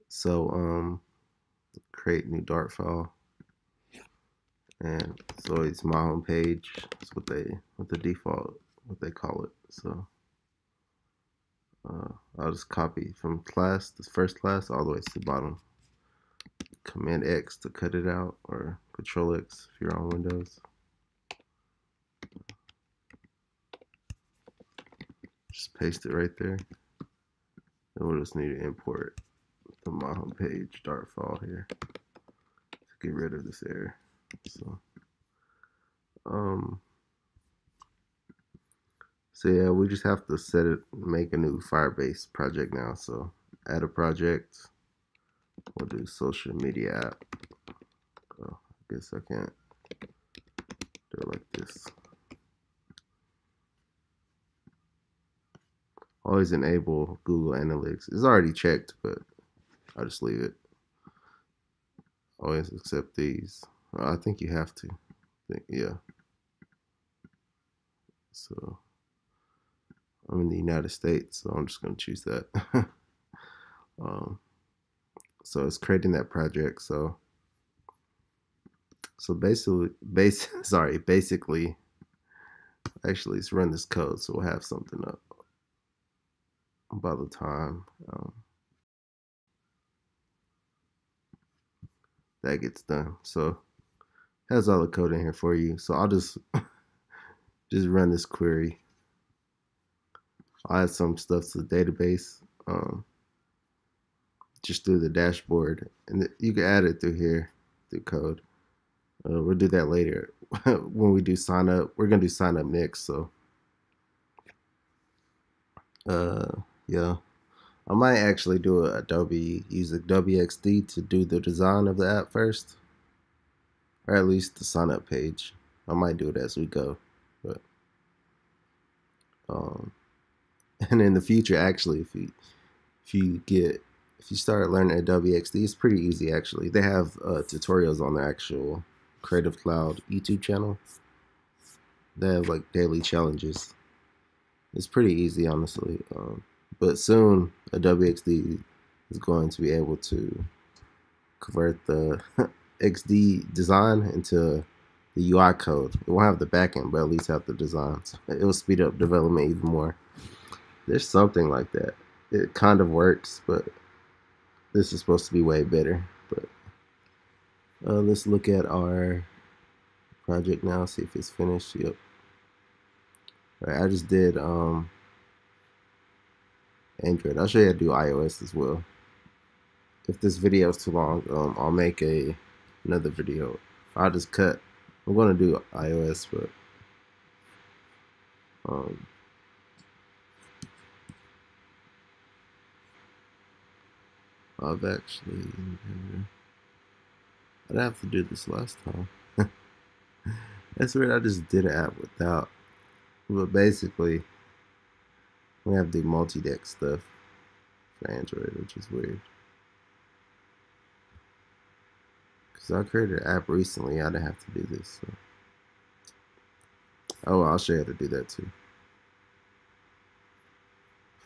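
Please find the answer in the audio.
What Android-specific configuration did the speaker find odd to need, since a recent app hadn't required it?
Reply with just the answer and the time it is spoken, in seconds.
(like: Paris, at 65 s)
multidex, at 206 s.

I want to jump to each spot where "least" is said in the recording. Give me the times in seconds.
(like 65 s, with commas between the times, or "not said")
124 s, 157 s.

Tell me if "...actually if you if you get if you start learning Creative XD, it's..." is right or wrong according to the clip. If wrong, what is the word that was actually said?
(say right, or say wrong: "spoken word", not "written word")
wrong: "Adobe", not "Creative".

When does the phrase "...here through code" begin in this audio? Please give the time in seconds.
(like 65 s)
107 s.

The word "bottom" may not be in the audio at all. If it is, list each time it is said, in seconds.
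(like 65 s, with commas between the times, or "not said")
15 s.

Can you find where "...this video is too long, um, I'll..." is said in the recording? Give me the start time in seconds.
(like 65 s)
180 s.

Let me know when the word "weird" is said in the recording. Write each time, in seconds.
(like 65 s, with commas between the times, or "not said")
200 s, 208 s.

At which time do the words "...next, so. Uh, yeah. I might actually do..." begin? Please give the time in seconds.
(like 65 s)
112 s.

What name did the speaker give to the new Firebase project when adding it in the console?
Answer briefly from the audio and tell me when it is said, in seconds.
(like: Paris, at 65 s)
social media app, at 46 s.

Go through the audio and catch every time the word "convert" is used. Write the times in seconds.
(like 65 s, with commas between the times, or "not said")
151 s.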